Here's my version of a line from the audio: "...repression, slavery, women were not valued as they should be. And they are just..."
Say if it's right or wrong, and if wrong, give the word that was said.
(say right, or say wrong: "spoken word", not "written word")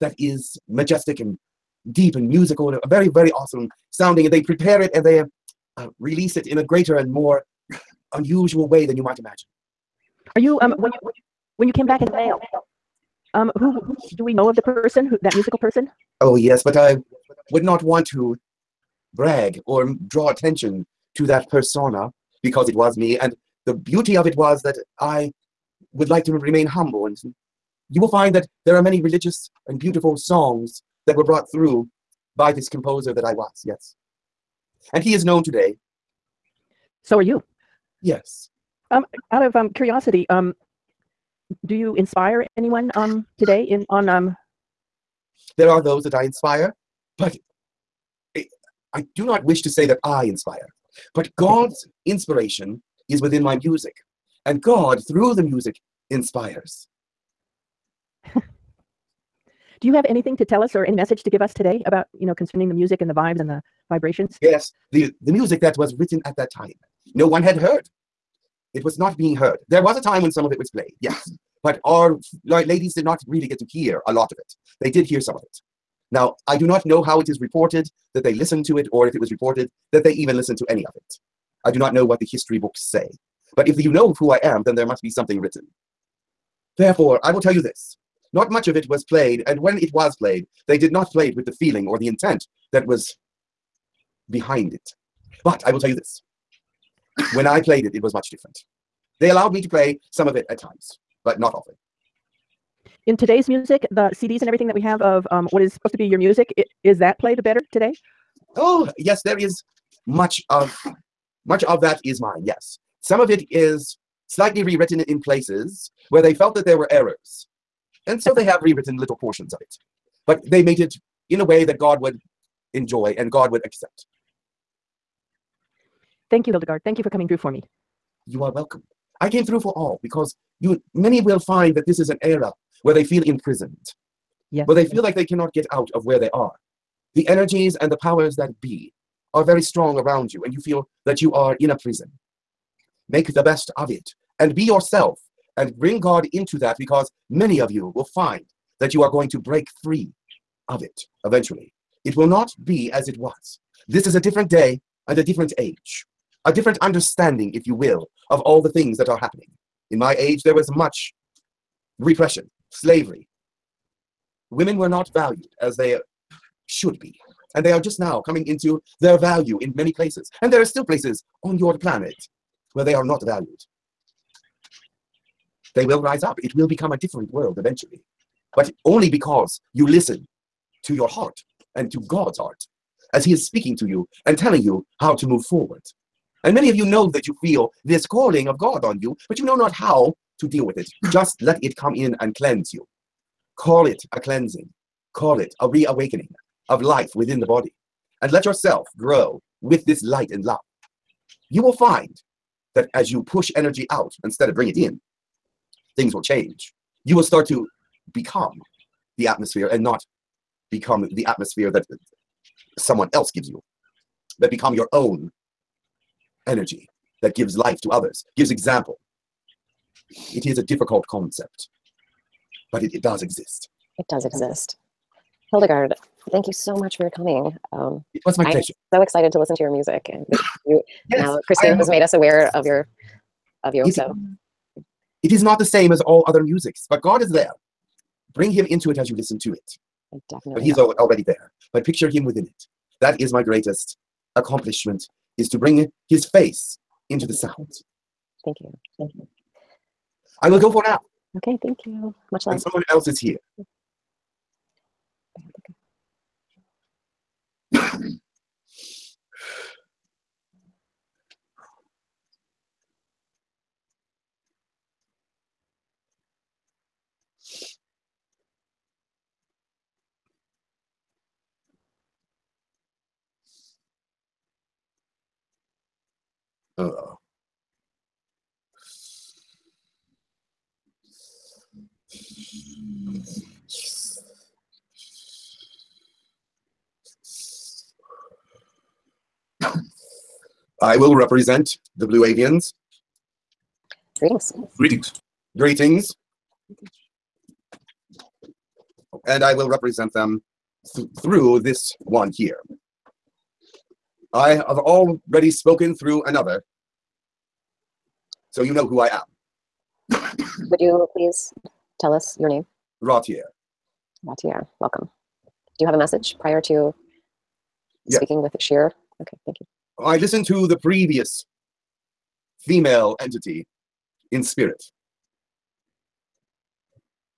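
right.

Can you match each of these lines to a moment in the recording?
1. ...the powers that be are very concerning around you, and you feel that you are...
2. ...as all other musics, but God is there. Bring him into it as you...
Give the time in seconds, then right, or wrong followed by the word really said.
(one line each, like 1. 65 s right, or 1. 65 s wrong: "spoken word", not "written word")
1. 137 s wrong: "strong", not "concerning"
2. 235 s right.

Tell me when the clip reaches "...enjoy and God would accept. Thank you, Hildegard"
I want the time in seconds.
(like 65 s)
122 s.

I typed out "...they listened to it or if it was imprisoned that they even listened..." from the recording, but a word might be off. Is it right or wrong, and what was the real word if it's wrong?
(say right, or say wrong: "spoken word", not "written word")
wrong: "reported", not "imprisoned".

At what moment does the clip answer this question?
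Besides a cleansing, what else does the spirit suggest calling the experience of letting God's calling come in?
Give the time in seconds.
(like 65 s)
195 s.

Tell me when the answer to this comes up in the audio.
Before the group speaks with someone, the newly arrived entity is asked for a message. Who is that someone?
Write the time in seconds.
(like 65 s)
318 s.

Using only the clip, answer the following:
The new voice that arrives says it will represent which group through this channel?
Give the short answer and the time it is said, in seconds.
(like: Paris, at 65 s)
the Blue Avians, at 292 s.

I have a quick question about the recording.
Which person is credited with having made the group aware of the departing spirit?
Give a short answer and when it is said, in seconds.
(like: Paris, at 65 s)
Christine, at 231 s.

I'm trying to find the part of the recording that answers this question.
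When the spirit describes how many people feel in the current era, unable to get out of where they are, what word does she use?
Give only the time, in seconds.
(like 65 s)
133 s.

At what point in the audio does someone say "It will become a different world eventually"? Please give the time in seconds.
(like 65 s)
176 s.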